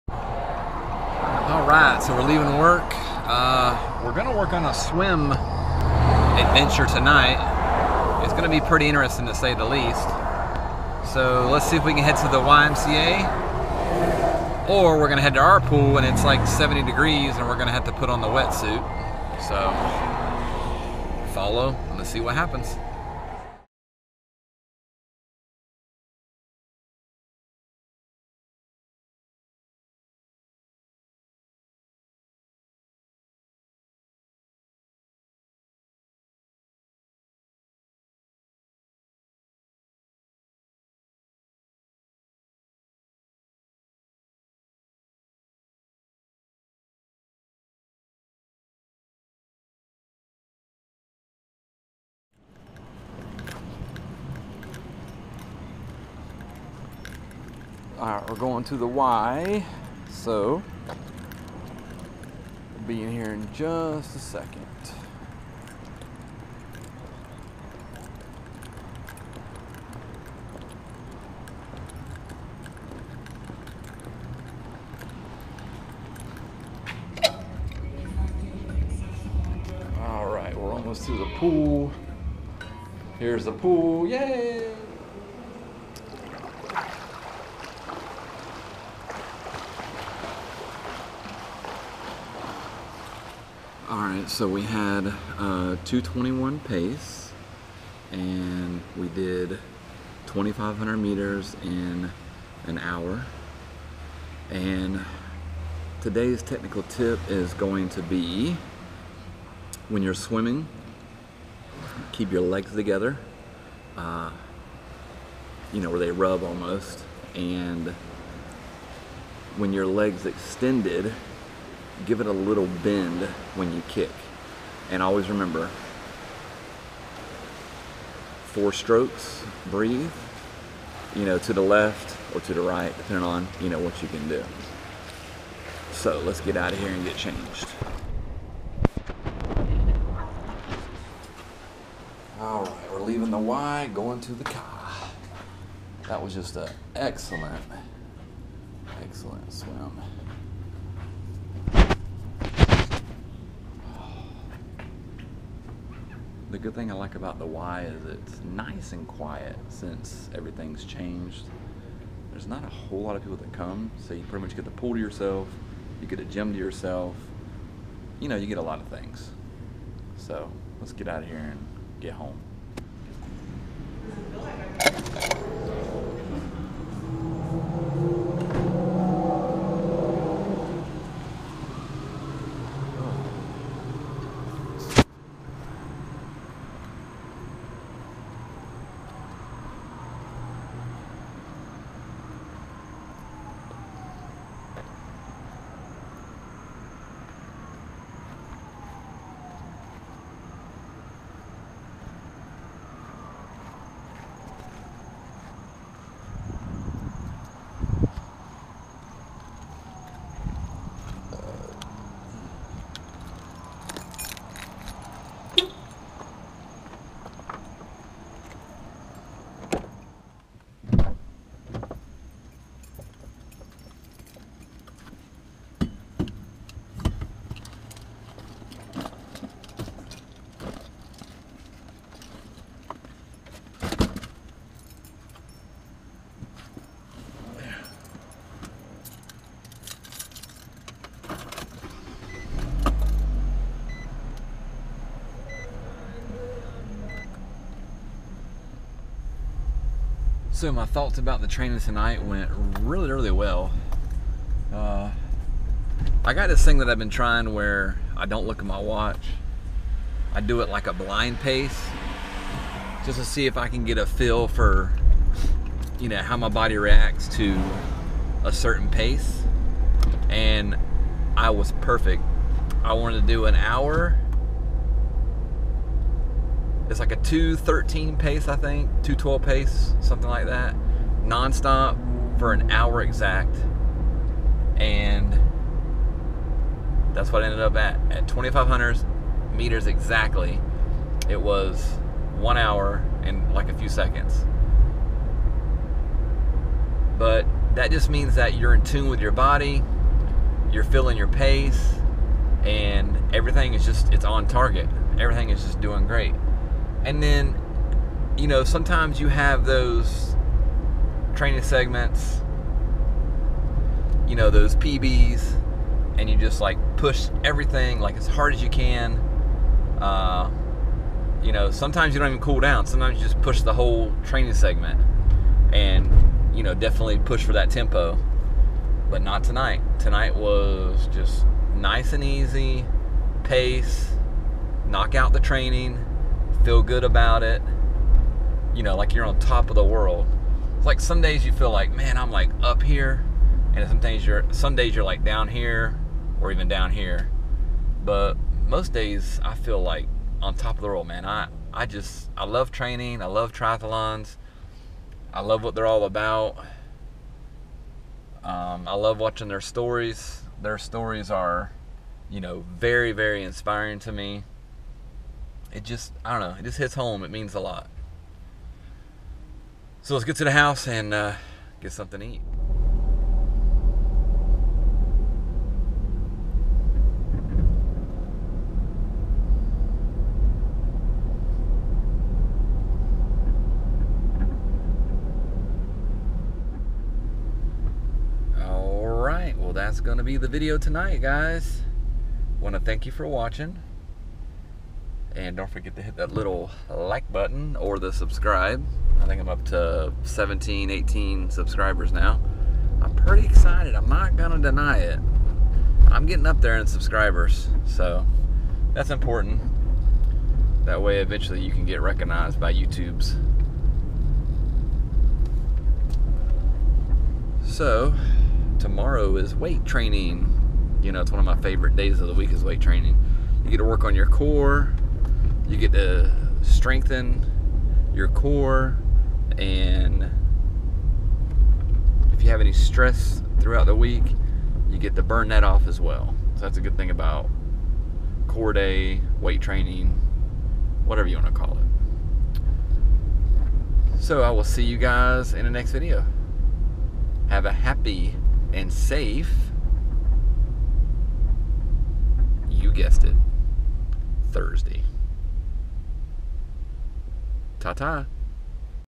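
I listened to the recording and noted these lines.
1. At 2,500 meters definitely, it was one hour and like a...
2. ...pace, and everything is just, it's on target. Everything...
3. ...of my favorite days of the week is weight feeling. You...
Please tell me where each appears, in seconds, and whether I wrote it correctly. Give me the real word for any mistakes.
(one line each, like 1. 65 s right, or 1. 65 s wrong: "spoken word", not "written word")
1. 288 s wrong: "exactly", not "definitely"
2. 301 s right
3. 421 s wrong: "training", not "feeling".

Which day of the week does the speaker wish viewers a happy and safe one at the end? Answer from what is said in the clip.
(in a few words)
Thursday.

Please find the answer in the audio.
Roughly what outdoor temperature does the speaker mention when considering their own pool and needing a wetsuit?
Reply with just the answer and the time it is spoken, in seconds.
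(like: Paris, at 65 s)
70 degrees, at 16 s.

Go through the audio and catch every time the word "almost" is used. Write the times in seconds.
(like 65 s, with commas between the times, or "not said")
80 s, 116 s.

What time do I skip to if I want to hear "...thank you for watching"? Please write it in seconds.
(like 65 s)
392 s.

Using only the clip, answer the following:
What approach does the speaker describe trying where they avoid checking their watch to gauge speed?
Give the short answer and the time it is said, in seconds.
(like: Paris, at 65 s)
blind pace, at 260 s.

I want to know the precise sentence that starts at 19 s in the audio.
So follow and let's see what happens.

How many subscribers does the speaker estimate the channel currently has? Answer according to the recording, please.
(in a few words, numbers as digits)
17 or 18.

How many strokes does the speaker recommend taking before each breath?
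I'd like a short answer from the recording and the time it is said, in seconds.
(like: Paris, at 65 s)
4, at 128 s.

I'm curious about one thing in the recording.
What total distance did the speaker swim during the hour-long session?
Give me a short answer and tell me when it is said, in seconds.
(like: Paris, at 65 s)
2,500 meters, at 100 s.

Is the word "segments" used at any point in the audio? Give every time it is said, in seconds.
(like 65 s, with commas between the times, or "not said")
311 s, 324 s.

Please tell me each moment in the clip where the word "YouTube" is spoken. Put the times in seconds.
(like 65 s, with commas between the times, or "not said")
412 s.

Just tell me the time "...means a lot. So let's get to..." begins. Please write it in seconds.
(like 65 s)
367 s.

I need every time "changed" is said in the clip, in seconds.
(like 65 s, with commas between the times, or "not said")
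137 s, 160 s.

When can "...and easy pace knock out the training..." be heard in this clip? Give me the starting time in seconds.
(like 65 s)
332 s.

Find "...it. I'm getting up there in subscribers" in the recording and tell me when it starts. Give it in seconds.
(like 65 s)
404 s.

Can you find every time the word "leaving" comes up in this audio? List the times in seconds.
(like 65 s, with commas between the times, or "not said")
2 s, 143 s.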